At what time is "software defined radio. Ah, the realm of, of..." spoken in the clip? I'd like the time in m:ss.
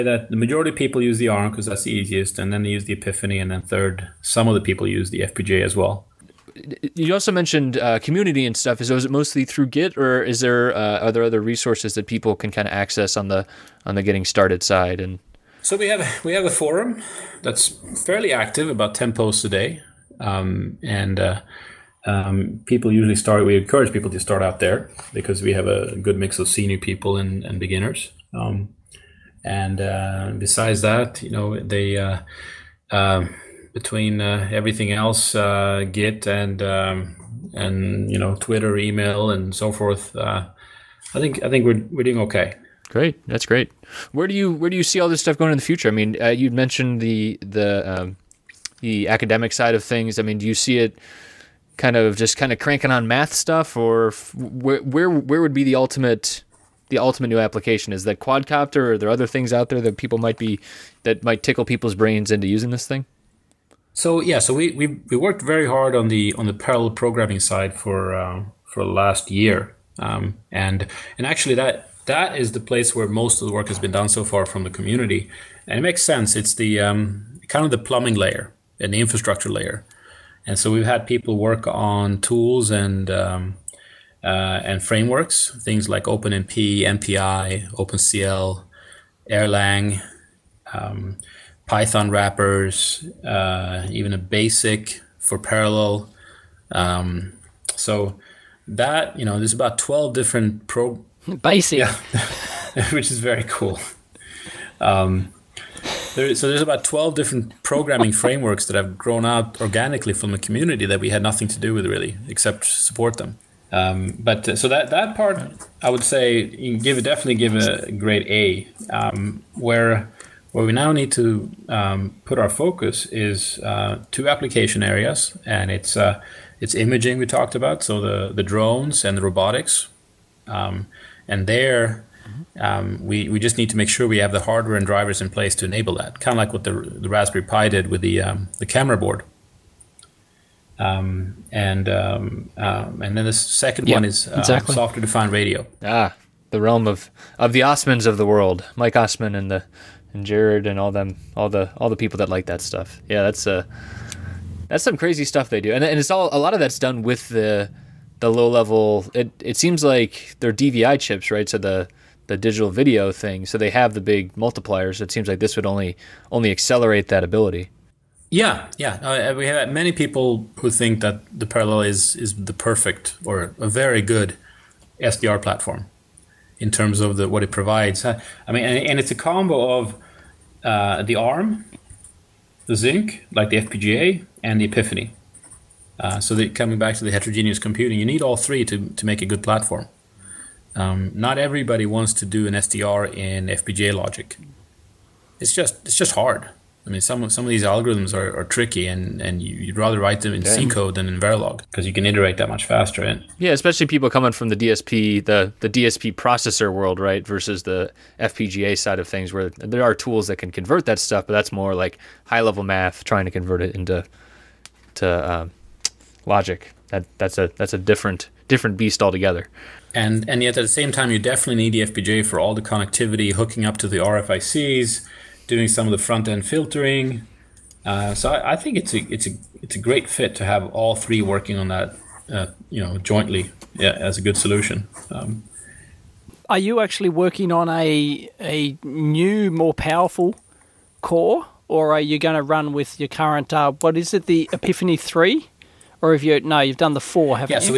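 2:24.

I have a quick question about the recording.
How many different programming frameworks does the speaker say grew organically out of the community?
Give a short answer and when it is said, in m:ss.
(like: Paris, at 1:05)
12, at 1:46.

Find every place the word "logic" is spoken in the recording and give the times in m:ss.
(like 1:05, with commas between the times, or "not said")
3:13, 3:36.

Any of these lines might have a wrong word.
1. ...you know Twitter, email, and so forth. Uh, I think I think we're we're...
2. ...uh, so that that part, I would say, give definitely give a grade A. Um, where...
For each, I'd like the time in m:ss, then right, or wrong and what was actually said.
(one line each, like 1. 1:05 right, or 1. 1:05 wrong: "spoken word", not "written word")
1. 0:38 right
2. 1:54 right.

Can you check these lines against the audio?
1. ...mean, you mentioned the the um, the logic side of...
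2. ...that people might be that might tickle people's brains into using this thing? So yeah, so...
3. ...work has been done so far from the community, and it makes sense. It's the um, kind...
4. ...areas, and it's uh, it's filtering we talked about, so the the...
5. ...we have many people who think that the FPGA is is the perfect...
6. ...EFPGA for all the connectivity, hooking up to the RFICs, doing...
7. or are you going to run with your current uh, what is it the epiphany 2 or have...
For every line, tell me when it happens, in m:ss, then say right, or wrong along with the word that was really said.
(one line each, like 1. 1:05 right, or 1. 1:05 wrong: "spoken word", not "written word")
1. 0:45 wrong: "academic", not "logic"
2. 0:59 right
3. 1:13 right
4. 2:04 wrong: "imaging", not "filtering"
5. 2:49 wrong: "Parallella", not "FPGA"
6. 3:41 right
7. 4:01 wrong: "3", not "2".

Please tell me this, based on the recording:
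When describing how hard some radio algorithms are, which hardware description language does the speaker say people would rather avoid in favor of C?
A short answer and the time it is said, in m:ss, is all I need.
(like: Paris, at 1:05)
Verilog, at 3:21.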